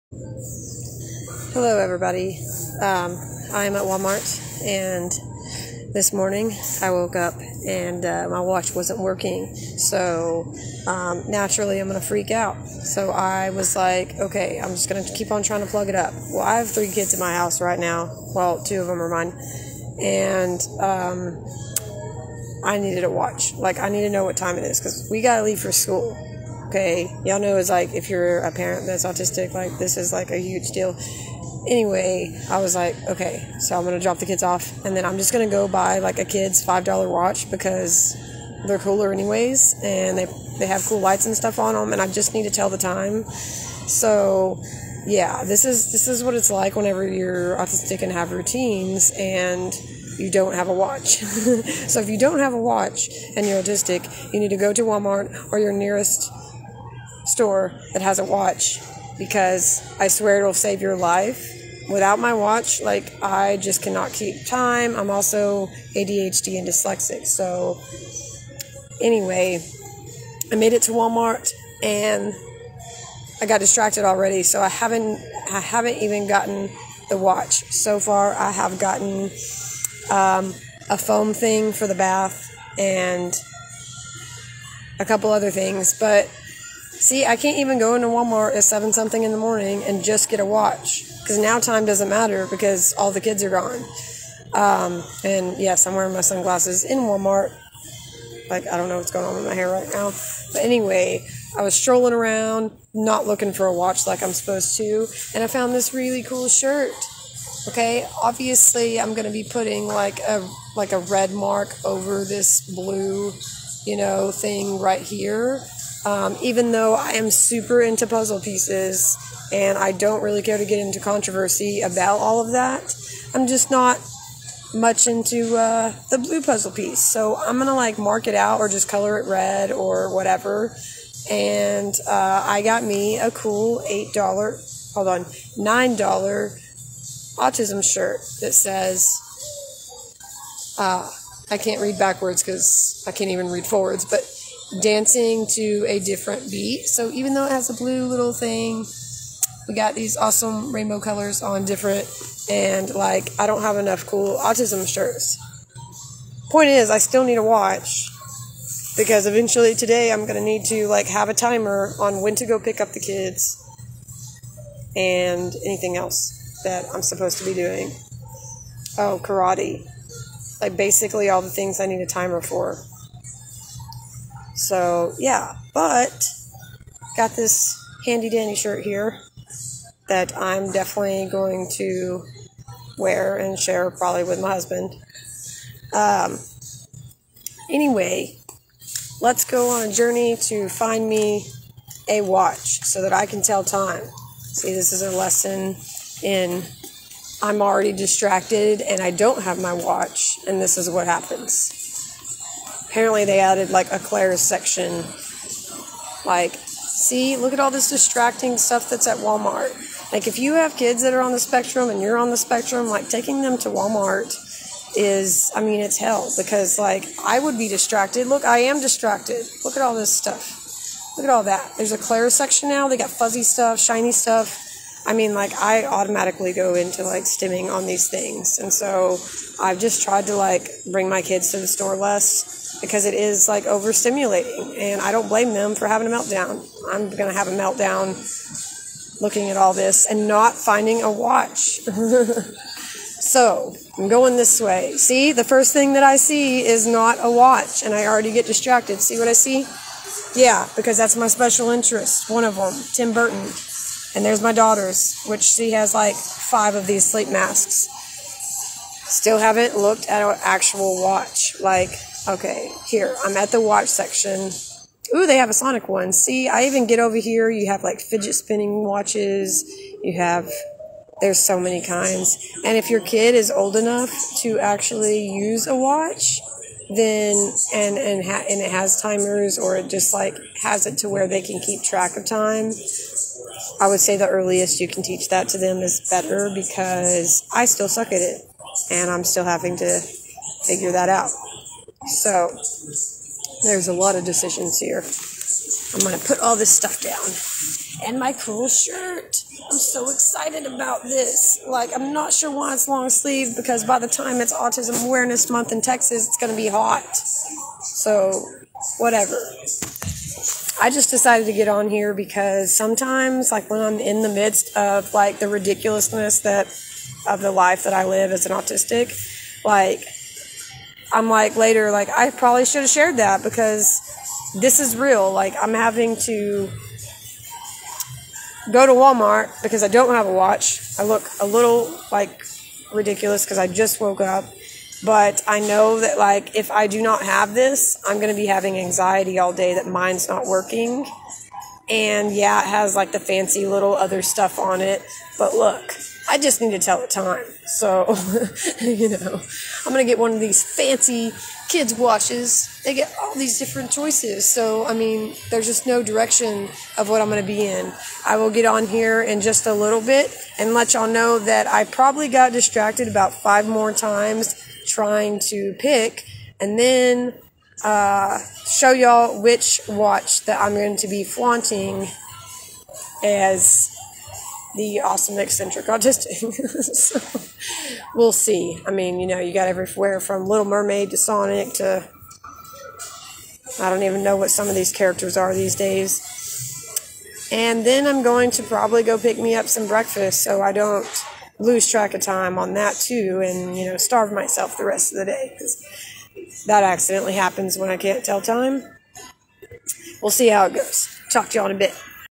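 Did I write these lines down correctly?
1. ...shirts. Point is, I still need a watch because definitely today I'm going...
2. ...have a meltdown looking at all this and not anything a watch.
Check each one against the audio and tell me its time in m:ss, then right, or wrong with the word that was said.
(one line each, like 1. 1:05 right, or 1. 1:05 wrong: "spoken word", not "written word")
1. 2:34 wrong: "eventually", not "definitely"
2. 3:57 wrong: "finding", not "anything".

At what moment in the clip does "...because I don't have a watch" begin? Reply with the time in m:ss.
5:29.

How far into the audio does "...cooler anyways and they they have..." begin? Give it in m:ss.
0:38.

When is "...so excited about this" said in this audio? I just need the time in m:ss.
4:59.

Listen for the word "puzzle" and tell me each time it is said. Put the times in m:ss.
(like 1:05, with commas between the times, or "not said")
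1:58, 2:06.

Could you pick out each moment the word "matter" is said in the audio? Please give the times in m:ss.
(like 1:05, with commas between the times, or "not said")
1:32.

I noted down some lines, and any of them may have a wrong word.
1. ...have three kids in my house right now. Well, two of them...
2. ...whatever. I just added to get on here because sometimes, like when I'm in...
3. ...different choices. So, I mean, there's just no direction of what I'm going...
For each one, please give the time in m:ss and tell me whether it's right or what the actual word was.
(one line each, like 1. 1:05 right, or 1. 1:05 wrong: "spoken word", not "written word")
1. 0:16 right
2. 5:08 wrong: "decided", not "added"
3. 5:53 right.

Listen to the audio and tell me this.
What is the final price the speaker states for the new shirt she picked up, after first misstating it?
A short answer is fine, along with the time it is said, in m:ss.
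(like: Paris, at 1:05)
$9, at 2:15.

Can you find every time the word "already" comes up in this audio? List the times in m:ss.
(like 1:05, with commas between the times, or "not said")
1:14, 3:17, 4:08.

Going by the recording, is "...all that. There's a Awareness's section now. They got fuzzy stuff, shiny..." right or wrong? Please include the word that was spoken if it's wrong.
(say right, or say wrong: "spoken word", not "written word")
wrong: "Claire", not "Awareness".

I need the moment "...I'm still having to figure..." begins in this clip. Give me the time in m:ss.
4:49.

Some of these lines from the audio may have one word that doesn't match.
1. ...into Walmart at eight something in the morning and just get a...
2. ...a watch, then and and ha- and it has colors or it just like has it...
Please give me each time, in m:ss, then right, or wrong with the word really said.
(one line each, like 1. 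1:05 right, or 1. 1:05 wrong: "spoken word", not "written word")
1. 1:27 wrong: "seven", not "eight"
2. 4:35 wrong: "timers", not "colors".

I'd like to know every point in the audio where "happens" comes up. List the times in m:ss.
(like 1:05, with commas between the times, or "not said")
3:21, 6:37.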